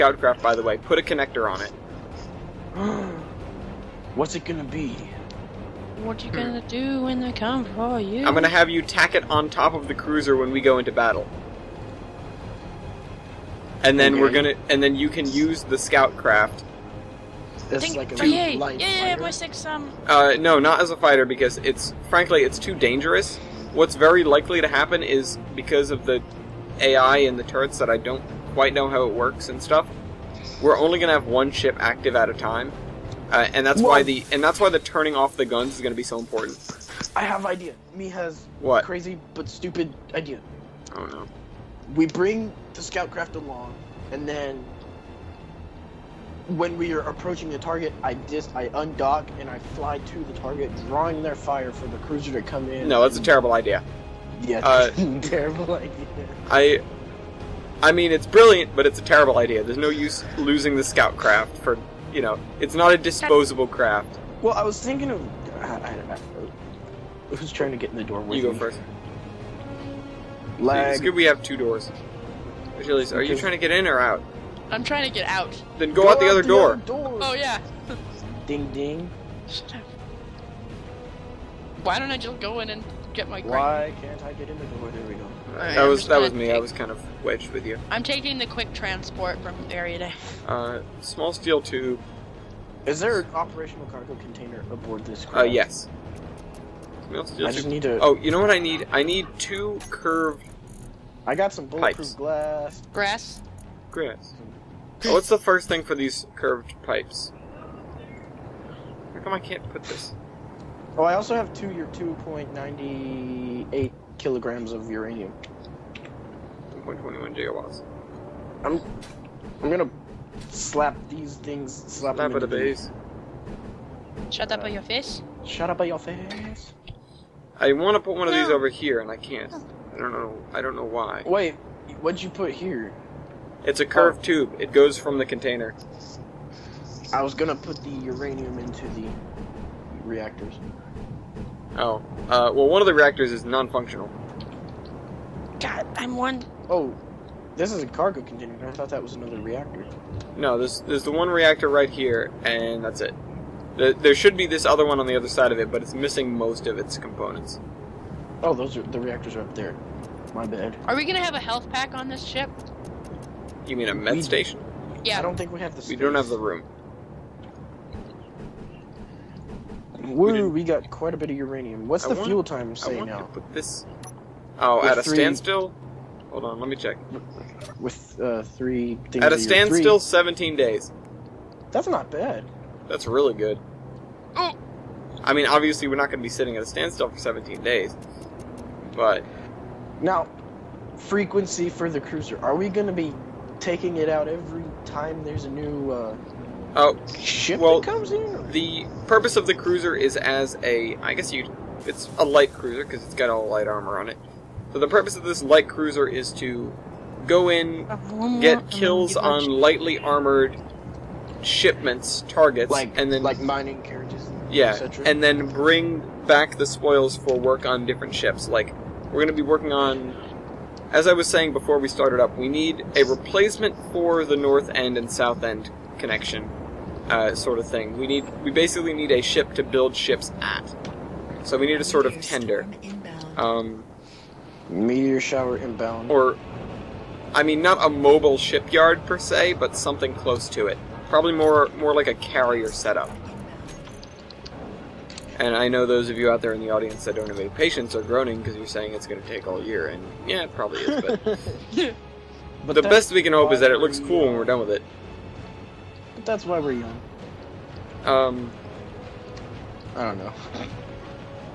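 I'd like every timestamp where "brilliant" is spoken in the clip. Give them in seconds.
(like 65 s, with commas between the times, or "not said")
58 s.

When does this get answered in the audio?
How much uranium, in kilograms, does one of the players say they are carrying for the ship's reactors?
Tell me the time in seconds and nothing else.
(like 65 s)
111 s.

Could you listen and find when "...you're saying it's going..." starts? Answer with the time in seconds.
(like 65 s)
248 s.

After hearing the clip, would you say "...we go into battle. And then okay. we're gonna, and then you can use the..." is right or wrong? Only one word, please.
right.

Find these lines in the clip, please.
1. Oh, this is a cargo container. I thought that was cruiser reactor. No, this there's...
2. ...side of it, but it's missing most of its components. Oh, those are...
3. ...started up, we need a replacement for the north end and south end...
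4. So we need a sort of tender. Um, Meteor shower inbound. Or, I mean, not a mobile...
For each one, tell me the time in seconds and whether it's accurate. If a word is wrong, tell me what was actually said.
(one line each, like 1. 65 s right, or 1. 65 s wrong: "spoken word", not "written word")
1. 146 s wrong: "another", not "cruiser"
2. 155 s right
3. 221 s right
4. 231 s right.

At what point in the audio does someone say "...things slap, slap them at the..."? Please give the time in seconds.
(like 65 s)
121 s.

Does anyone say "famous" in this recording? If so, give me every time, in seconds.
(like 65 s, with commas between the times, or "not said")
not said.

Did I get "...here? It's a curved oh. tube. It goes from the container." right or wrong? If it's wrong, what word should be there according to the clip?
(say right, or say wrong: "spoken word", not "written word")
right.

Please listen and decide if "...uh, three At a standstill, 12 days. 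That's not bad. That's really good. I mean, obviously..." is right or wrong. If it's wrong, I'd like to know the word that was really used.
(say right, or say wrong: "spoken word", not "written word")
wrong: "17", not "12".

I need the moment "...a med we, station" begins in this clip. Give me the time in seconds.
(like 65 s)
163 s.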